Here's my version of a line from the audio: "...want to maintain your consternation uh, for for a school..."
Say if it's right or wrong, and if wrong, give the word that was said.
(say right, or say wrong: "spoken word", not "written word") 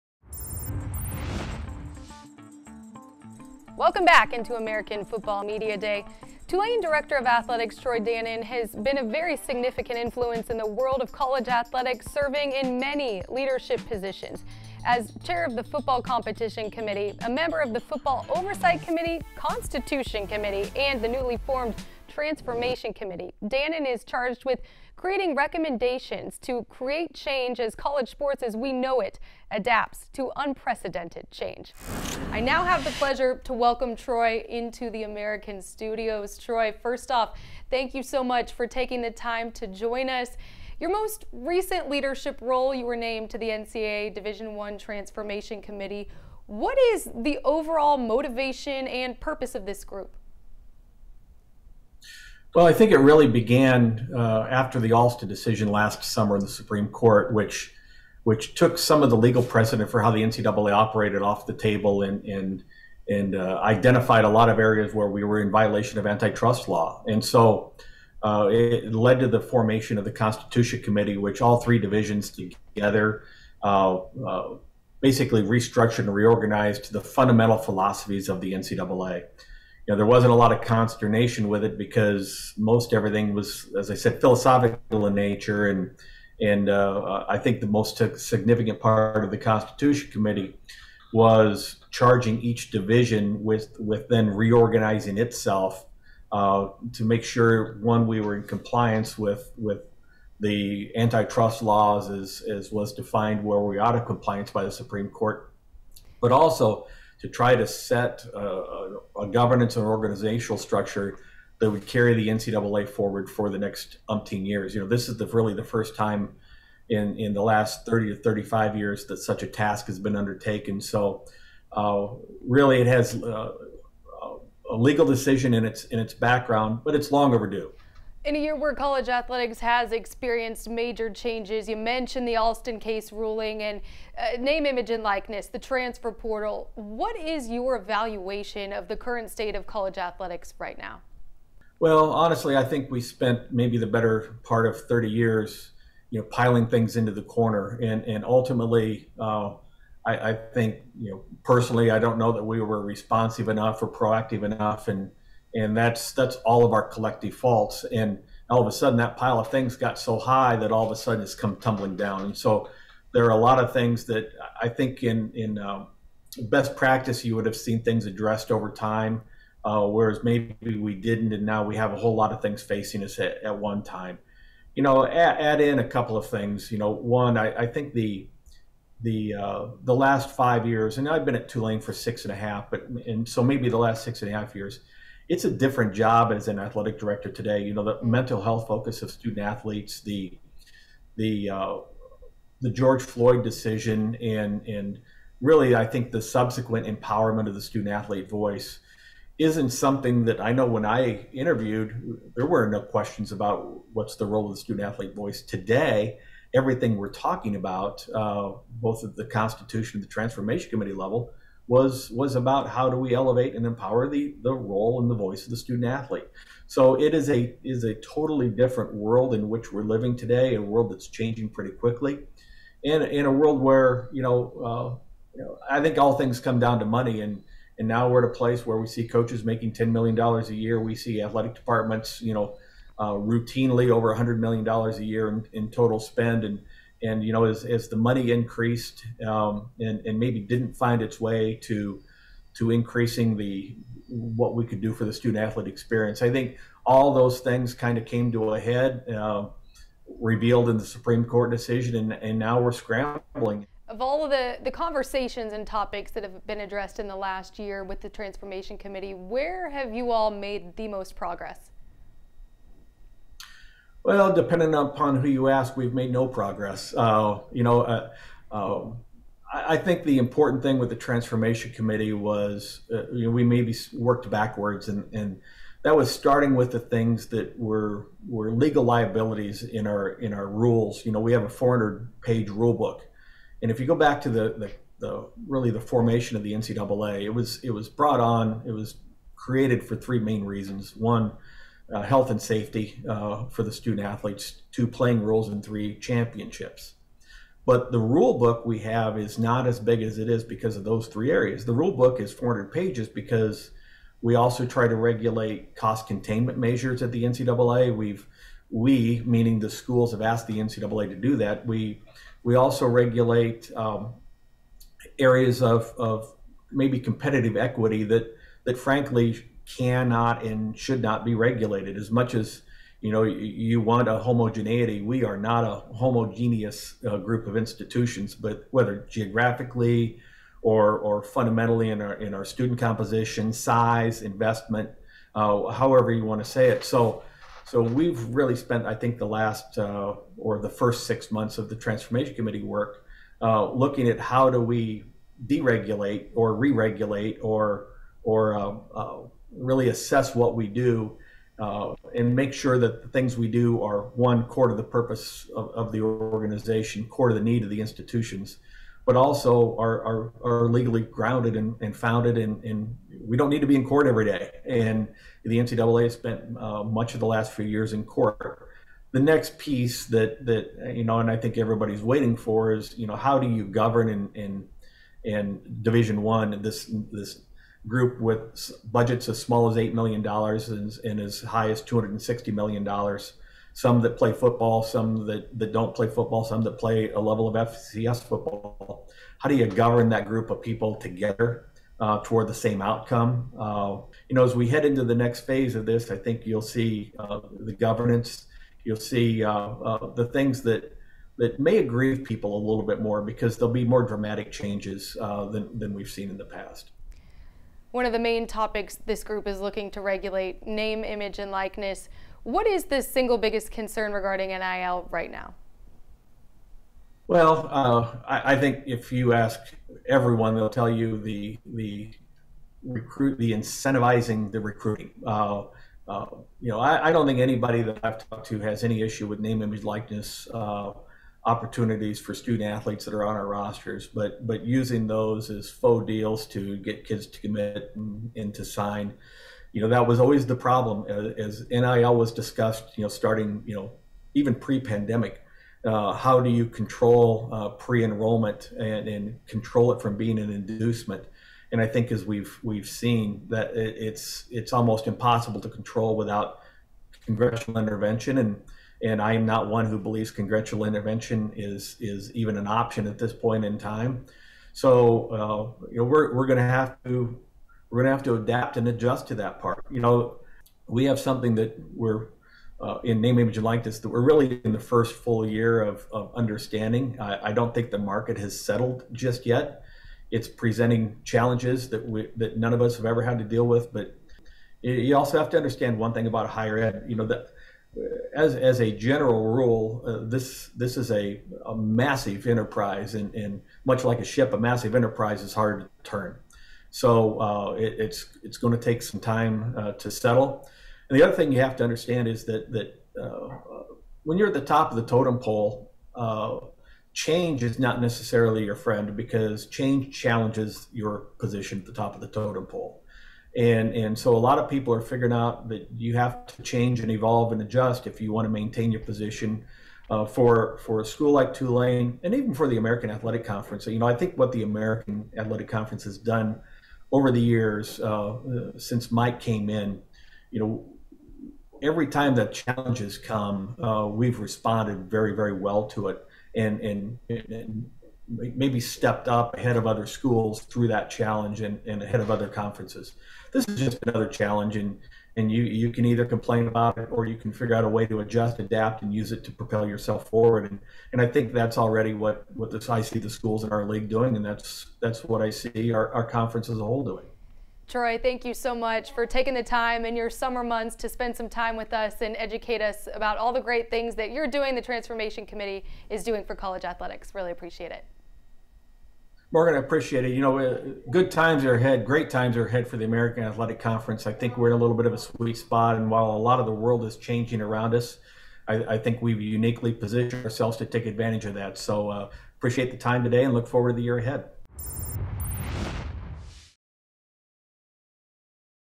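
wrong: "position", not "consternation".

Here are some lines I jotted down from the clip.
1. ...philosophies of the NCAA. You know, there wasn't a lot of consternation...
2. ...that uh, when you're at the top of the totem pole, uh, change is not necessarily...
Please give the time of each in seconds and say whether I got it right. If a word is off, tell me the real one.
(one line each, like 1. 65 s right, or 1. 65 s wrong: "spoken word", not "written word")
1. 77 s right
2. 502 s right.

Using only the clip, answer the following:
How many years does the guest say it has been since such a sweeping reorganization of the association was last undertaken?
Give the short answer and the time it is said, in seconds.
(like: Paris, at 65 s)
30 to 35 years, at 117 s.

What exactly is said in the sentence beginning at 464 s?
So uh, you know we're we're going to have to we're going to have to adapt and adjust to that part.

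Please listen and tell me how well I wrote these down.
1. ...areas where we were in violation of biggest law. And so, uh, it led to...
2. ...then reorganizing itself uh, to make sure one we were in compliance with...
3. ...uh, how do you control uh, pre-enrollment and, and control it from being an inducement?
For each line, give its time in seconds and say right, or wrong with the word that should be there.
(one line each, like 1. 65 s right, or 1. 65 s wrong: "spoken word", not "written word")
1. 64 s wrong: "antitrust", not "biggest"
2. 94 s right
3. 445 s right.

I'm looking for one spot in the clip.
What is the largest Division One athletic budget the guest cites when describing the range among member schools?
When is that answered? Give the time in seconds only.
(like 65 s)
381 s.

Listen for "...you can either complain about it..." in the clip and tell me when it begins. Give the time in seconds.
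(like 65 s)
545 s.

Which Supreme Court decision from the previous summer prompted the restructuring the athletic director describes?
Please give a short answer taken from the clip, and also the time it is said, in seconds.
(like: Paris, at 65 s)
Alston decision, at 54 s.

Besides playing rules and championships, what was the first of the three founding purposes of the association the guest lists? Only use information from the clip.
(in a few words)
health and safety.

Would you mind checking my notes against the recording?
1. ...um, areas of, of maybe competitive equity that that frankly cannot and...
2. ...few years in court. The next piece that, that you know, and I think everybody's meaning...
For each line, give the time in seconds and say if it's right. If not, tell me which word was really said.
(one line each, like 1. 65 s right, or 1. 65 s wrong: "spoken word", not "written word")
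1. 313 s right
2. 367 s wrong: "waiting", not "meaning".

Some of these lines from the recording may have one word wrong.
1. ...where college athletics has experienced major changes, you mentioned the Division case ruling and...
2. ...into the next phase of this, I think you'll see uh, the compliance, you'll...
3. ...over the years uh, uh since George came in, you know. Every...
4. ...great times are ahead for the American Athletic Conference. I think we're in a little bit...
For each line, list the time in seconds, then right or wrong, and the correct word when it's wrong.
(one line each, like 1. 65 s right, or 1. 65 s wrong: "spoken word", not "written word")
1. 128 s wrong: "Alston", not "Division"
2. 394 s wrong: "governance", not "compliance"
3. 527 s wrong: "Mike", not "George"
4. 572 s right.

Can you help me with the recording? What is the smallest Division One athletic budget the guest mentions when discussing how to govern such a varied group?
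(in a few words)
$8 million.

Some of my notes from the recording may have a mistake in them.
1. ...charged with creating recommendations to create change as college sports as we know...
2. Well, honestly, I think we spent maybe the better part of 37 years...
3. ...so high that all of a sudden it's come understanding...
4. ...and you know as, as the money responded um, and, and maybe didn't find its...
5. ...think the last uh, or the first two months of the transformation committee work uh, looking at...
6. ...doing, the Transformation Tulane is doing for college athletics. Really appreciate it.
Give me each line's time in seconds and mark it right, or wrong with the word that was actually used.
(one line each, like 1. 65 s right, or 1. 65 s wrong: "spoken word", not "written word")
1. 24 s right
2. 141 s wrong: "30", not "37"
3. 159 s wrong: "tumbling", not "understanding"
4. 237 s wrong: "increased", not "responded"
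5. 338 s wrong: "six", not "two"
6. 564 s wrong: "Committee", not "Tulane".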